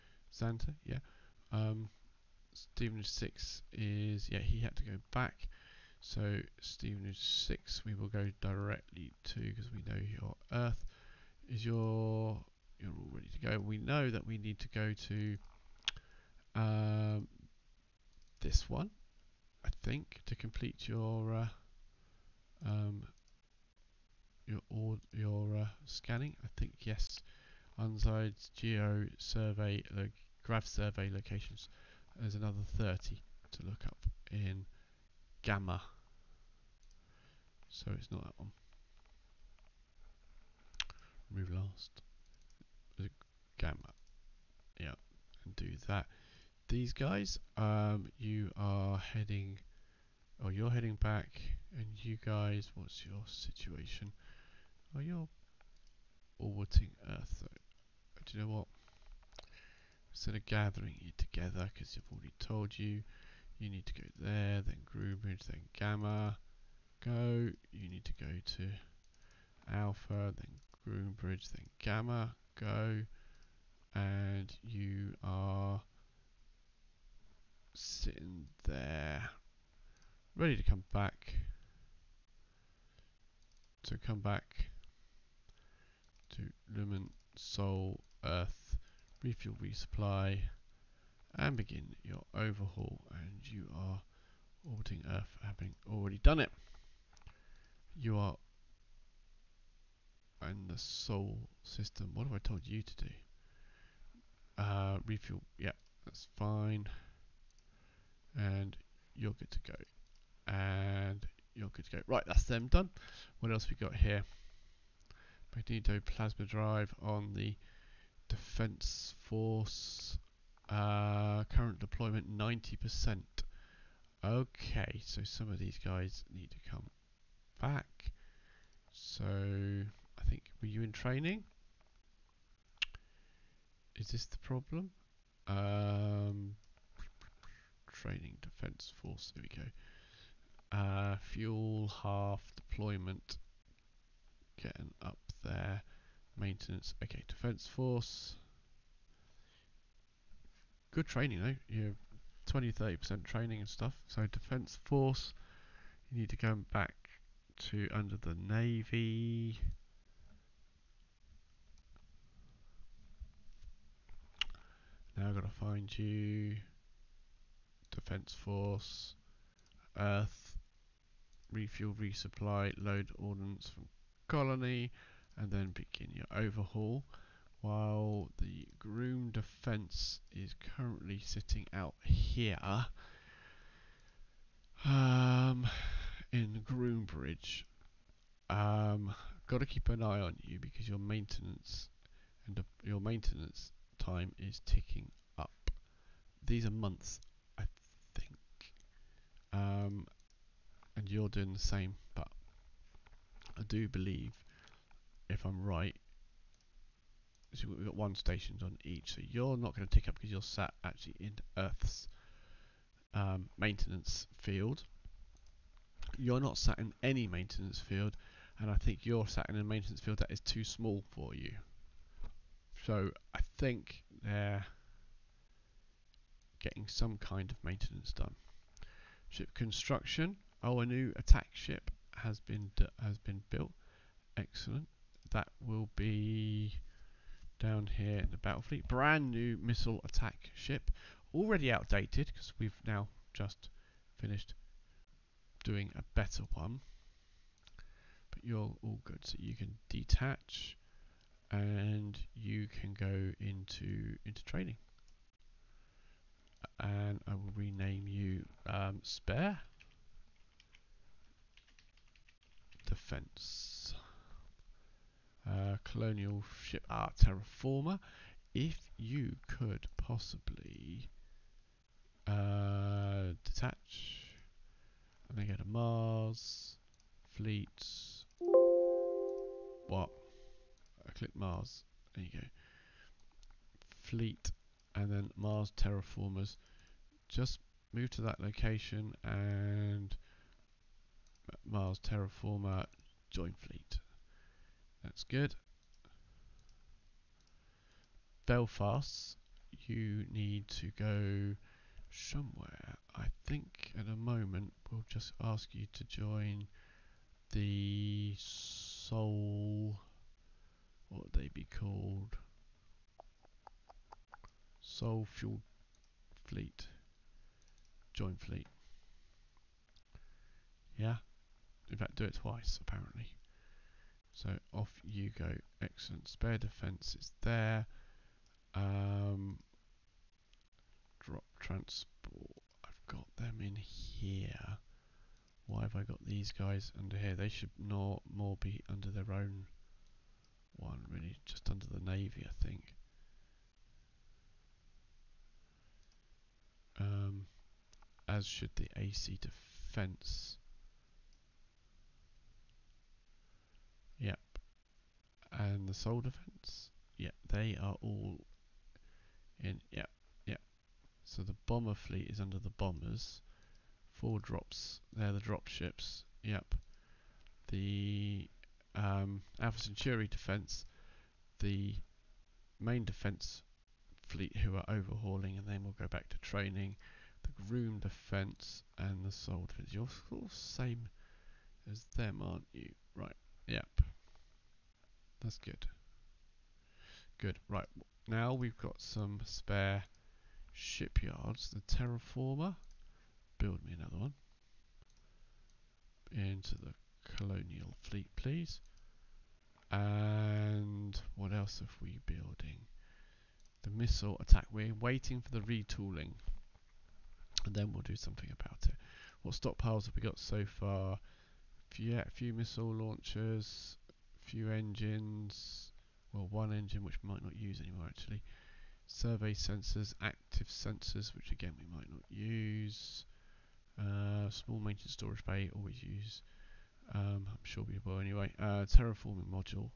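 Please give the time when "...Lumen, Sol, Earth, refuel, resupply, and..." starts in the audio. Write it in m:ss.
1:26.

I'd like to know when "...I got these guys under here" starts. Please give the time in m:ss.
5:35.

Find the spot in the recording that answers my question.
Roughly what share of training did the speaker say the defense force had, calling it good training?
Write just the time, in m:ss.
2:32.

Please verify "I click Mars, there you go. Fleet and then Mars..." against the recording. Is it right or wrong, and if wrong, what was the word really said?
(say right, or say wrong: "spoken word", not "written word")
right.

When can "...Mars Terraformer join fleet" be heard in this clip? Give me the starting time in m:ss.
4:51.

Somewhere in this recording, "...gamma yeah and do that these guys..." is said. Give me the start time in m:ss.
0:43.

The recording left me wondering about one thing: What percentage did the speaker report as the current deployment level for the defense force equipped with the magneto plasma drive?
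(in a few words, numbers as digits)
90%.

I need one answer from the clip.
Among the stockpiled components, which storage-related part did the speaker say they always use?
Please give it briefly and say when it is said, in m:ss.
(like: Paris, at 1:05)
Small maintenance storage bay, at 7:04.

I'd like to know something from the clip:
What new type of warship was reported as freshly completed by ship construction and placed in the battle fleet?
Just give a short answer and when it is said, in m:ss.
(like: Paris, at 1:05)
Missile attack ship, at 3:59.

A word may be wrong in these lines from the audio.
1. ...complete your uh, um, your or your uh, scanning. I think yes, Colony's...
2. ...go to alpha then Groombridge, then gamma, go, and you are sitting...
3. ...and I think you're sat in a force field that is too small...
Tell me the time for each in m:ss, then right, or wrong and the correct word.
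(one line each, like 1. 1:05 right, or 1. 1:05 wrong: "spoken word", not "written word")
1. 0:20 wrong: "Unside", not "Colony"
2. 1:08 right
3. 3:38 wrong: "maintenance", not "force".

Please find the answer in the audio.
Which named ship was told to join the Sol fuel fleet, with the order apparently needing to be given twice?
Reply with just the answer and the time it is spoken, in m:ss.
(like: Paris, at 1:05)
Belfast, at 4:58.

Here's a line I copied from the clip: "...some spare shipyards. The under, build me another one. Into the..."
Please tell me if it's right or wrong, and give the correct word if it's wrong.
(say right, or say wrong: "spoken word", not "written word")
wrong: "terraformer", not "under".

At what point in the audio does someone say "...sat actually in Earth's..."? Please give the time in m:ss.
3:30.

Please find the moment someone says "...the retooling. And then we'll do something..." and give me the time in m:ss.
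6:45.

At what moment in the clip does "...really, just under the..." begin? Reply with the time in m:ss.
5:41.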